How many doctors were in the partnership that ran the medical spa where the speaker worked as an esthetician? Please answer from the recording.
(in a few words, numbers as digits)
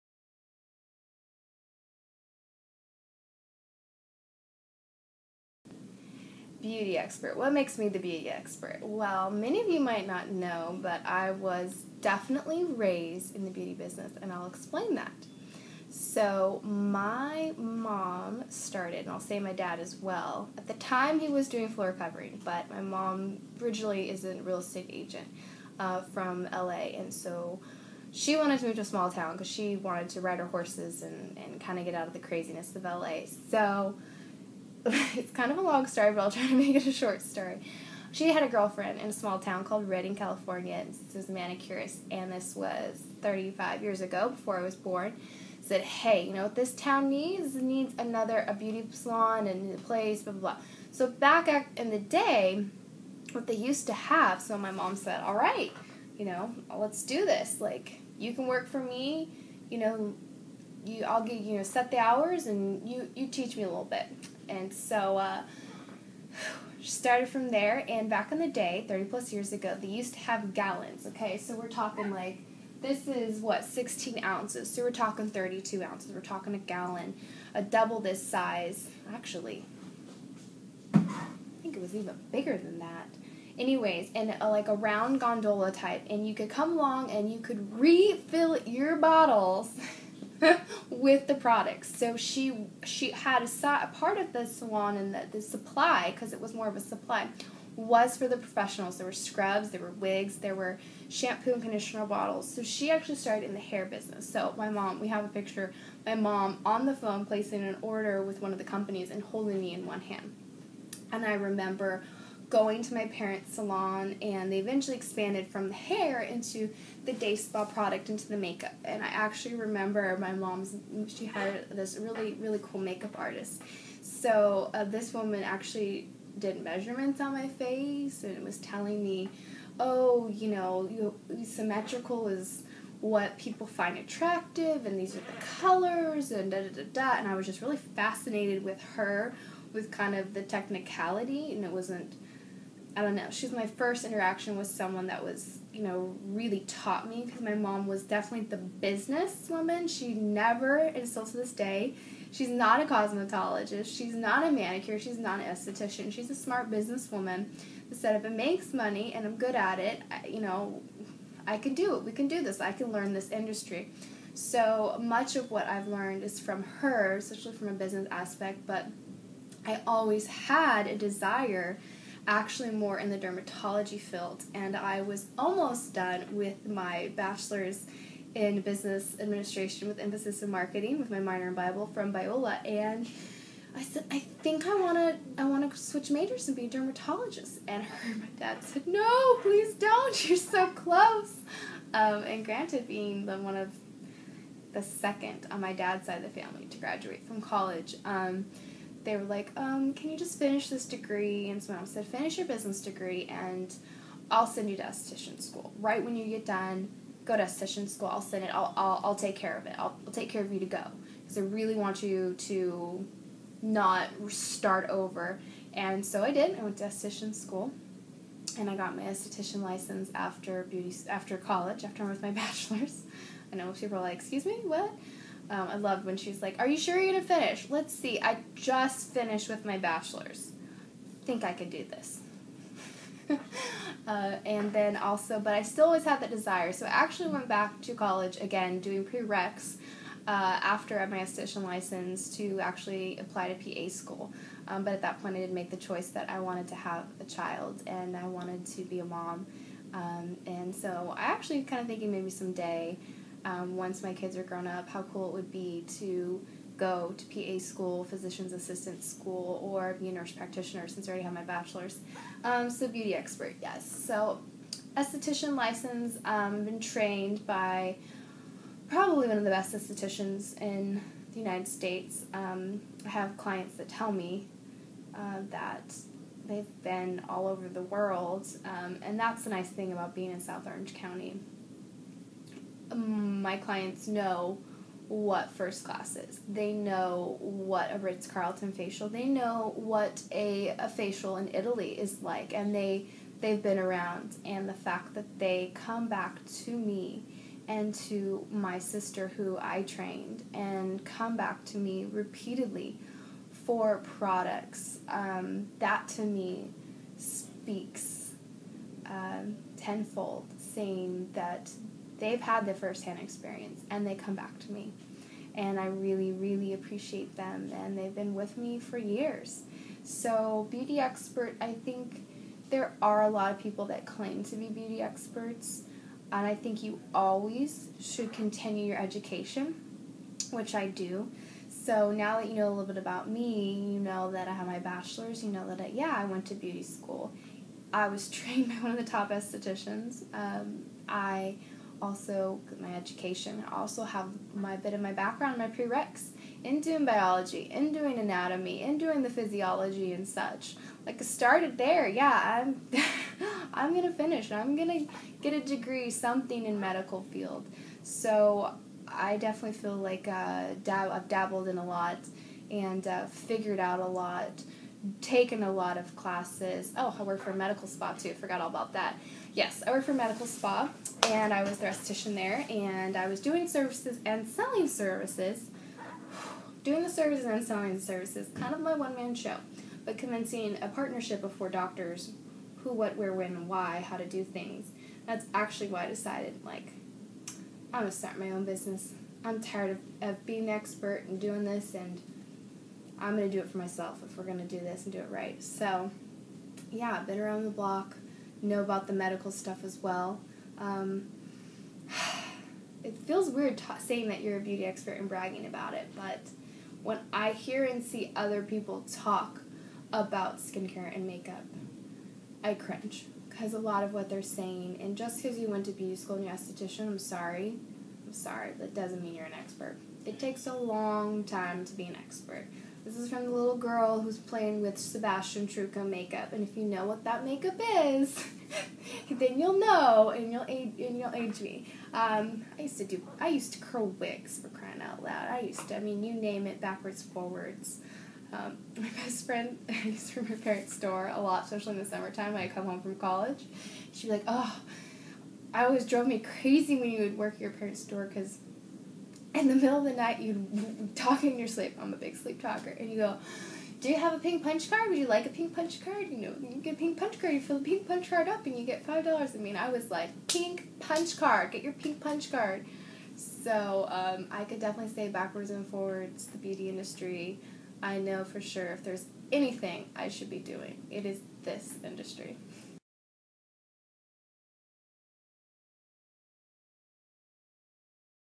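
4.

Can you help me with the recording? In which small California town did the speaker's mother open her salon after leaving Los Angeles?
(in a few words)
Redding.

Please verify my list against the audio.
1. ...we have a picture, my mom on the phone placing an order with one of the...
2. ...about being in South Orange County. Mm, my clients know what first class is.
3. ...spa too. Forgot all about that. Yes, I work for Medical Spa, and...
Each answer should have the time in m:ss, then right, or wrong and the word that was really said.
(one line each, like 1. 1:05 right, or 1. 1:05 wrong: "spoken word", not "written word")
1. 1:44 right
2. 4:39 right
3. 6:07 right.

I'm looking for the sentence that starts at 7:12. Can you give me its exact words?
Um, I used to do, I used to curl wigs for crying out loud.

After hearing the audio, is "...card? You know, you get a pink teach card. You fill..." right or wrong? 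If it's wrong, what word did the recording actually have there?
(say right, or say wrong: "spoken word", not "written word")
wrong: "punch", not "teach".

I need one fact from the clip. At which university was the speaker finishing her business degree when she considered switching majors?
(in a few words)
Biola.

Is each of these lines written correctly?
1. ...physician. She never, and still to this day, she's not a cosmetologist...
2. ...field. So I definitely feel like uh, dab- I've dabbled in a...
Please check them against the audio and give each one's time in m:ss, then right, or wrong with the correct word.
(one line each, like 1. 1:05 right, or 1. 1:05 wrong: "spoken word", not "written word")
1. 2:28 wrong: "businesswoman", not "physician"
2. 5:57 right.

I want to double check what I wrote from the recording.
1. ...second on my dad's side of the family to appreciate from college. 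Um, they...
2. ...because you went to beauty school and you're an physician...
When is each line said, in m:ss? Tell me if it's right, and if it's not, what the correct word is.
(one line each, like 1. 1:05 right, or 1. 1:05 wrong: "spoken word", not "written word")
1. 3:14 wrong: "graduate", not "appreciate"
2. 6:55 wrong: "esthetician", not "physician".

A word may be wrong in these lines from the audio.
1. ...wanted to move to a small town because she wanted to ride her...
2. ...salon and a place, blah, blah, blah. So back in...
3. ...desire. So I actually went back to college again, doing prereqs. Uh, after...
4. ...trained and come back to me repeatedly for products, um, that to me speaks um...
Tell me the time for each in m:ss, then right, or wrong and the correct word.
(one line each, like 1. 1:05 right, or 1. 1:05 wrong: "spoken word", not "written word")
1. 0:28 right
2. 0:48 right
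3. 3:56 right
4. 4:59 right.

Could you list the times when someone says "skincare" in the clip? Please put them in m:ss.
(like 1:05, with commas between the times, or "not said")
6:50.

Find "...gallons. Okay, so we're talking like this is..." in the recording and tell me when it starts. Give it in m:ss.
1:10.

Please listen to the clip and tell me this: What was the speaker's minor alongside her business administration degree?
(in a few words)
Bible.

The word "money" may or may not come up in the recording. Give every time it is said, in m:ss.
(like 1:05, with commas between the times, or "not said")
2:38.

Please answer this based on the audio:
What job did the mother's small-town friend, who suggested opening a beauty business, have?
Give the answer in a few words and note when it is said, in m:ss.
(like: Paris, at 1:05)
Manicurist, at 0:41.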